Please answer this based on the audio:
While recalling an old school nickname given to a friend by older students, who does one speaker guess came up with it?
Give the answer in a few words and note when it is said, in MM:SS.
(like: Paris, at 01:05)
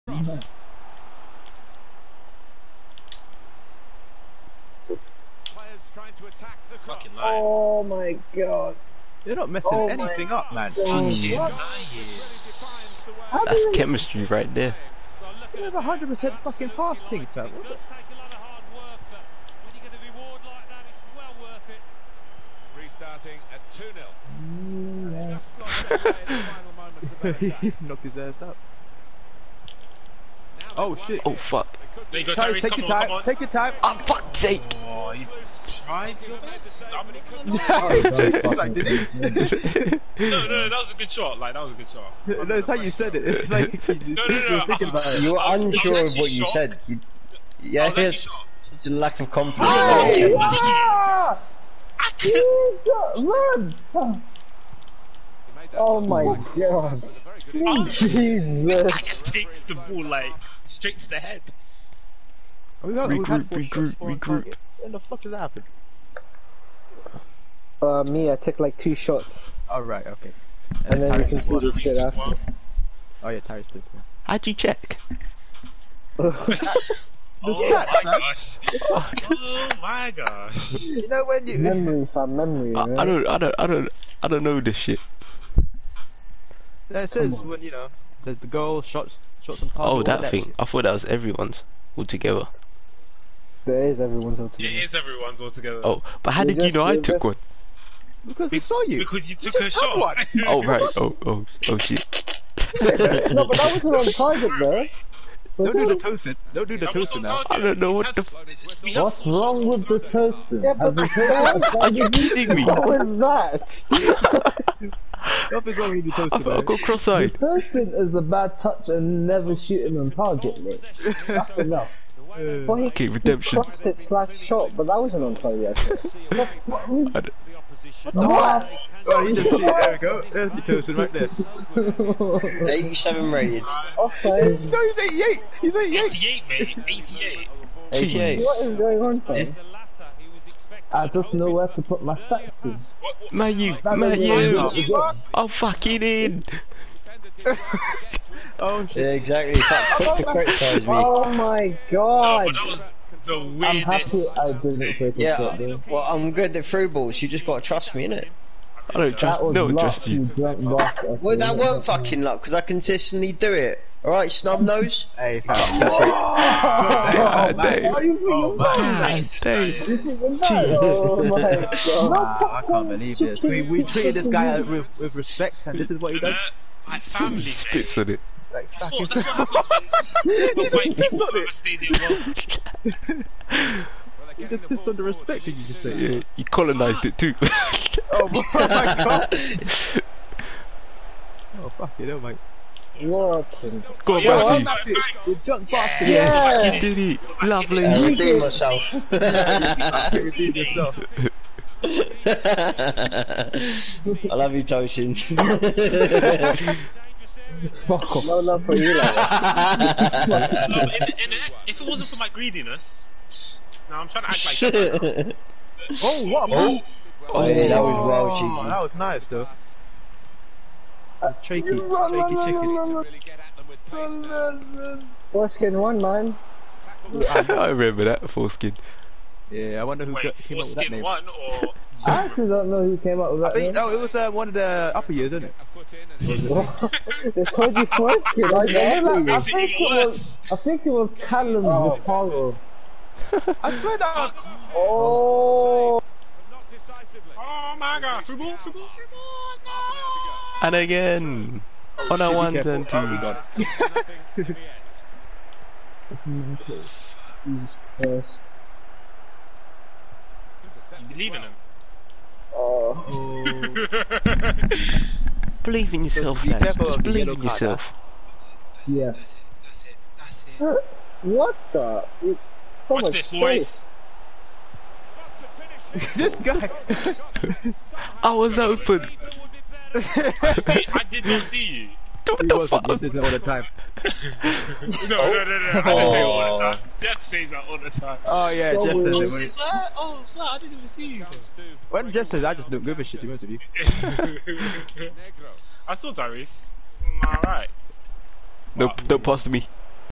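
Callum, at 04:00.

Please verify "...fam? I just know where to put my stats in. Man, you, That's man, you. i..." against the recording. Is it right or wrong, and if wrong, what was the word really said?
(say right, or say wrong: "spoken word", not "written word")
right.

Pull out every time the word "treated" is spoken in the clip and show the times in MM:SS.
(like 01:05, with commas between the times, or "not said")
02:53.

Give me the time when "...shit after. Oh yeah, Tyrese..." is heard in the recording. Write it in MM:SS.
01:11.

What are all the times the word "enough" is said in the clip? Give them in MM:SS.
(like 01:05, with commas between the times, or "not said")
02:01.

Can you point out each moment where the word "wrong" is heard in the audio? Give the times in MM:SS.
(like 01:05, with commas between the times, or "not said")
01:49, 01:55.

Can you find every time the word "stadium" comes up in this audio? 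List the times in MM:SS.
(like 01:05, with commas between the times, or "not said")
03:01.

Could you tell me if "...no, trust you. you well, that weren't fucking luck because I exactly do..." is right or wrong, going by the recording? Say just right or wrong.
wrong.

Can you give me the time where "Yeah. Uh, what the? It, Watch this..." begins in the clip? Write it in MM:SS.
04:28.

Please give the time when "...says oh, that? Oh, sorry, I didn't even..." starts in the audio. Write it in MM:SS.
04:49.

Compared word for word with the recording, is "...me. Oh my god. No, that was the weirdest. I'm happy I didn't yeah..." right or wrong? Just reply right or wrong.
right.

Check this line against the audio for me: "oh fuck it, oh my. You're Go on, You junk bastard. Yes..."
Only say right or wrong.
right.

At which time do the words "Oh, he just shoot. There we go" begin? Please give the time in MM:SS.
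02:08.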